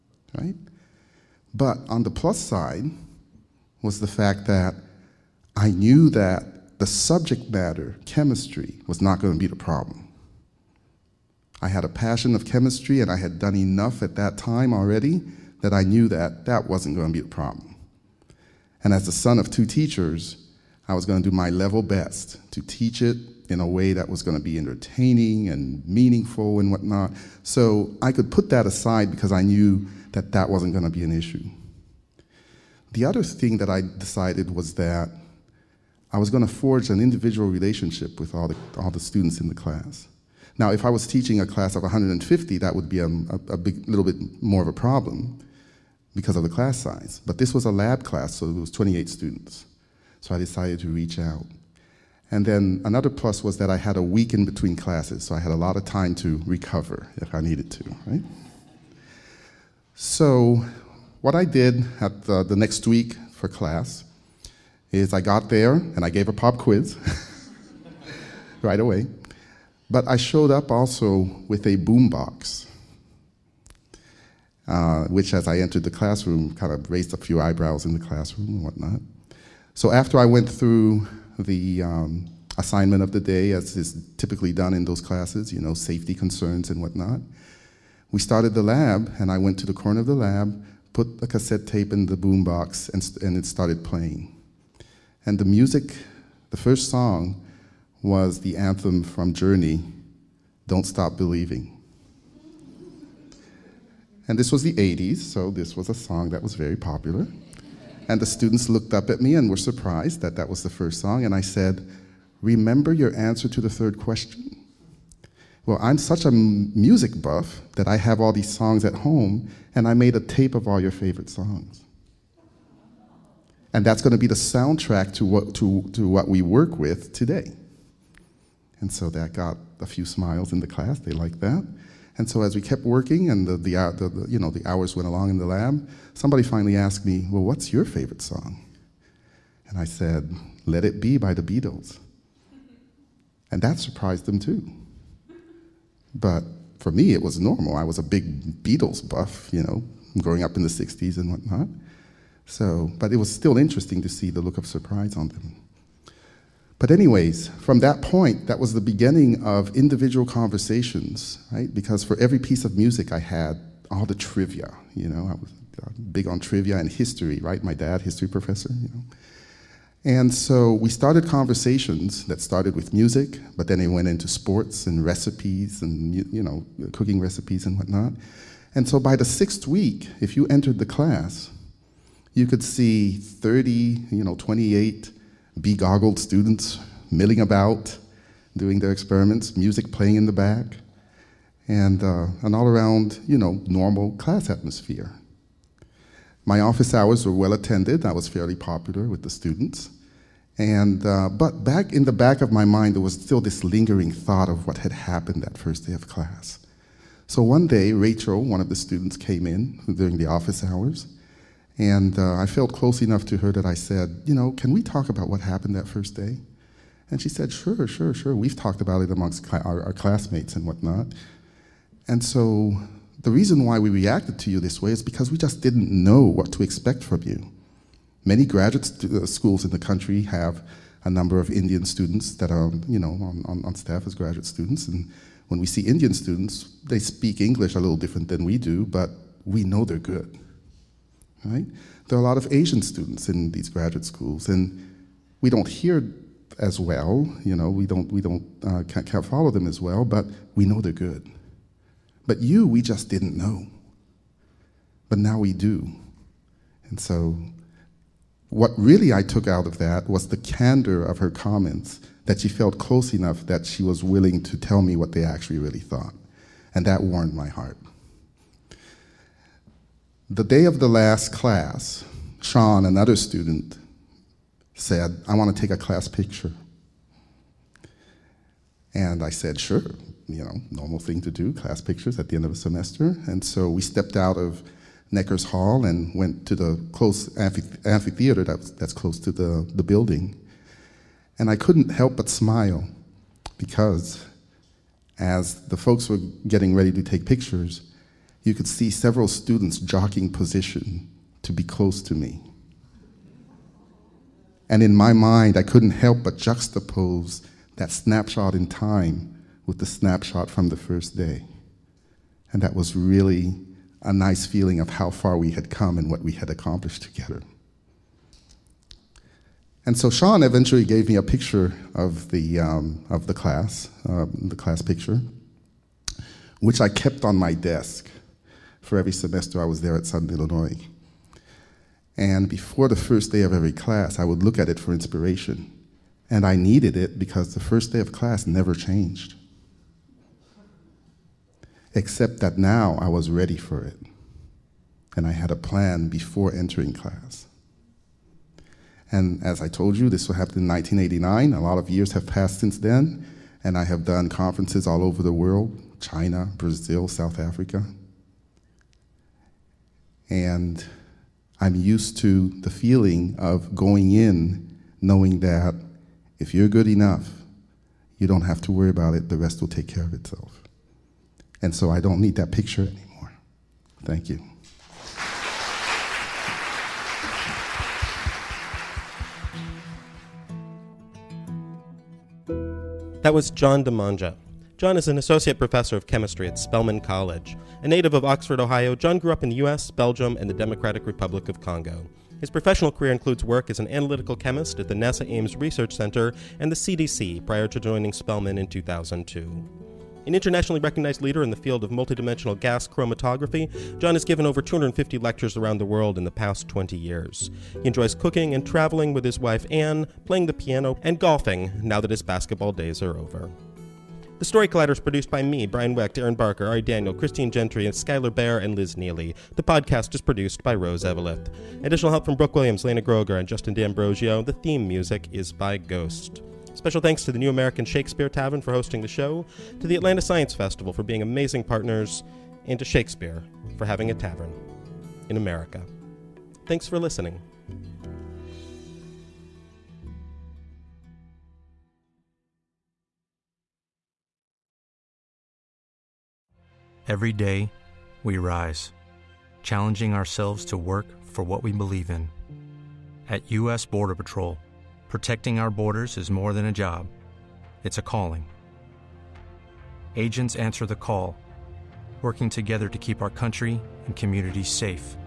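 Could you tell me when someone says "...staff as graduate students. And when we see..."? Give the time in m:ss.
3:53.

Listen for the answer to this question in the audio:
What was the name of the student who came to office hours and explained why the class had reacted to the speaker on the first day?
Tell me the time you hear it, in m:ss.
3:27.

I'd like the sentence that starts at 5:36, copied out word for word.
And I needed it because the first day of class never changed.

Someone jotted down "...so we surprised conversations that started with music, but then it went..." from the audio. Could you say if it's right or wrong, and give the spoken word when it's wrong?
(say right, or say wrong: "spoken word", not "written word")
wrong: "started", not "surprised".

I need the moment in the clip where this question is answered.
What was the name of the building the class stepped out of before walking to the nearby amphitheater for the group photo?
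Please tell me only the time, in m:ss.
4:45.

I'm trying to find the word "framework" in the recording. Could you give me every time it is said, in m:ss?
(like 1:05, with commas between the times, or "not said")
not said.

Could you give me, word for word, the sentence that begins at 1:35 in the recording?
And the music, the first song, was the anthem from Journey, Don't Stop Believing.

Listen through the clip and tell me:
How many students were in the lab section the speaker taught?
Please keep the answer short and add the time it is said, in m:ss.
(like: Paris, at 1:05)
28, at 0:48.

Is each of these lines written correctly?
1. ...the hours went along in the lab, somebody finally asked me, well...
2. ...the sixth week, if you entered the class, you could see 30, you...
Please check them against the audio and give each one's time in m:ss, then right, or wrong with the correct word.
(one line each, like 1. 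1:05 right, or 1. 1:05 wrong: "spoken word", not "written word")
1. 2:14 right
2. 2:59 right.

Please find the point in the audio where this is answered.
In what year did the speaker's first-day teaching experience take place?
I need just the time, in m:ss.
5:50.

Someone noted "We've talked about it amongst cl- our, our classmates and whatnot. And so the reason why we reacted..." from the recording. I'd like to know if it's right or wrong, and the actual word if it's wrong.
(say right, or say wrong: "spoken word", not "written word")
right.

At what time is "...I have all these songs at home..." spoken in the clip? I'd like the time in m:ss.
1:57.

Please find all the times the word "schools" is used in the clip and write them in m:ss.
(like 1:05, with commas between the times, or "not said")
3:49, 4:04.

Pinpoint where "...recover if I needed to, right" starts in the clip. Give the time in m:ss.
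0:56.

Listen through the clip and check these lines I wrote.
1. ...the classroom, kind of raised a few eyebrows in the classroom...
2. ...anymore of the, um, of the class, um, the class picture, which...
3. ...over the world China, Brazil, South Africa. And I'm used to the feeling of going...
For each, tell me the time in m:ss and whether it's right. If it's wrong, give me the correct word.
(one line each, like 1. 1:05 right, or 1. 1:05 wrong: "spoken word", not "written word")
1. 1:15 right
2. 5:21 wrong: "picture", not "anymore"
3. 5:55 right.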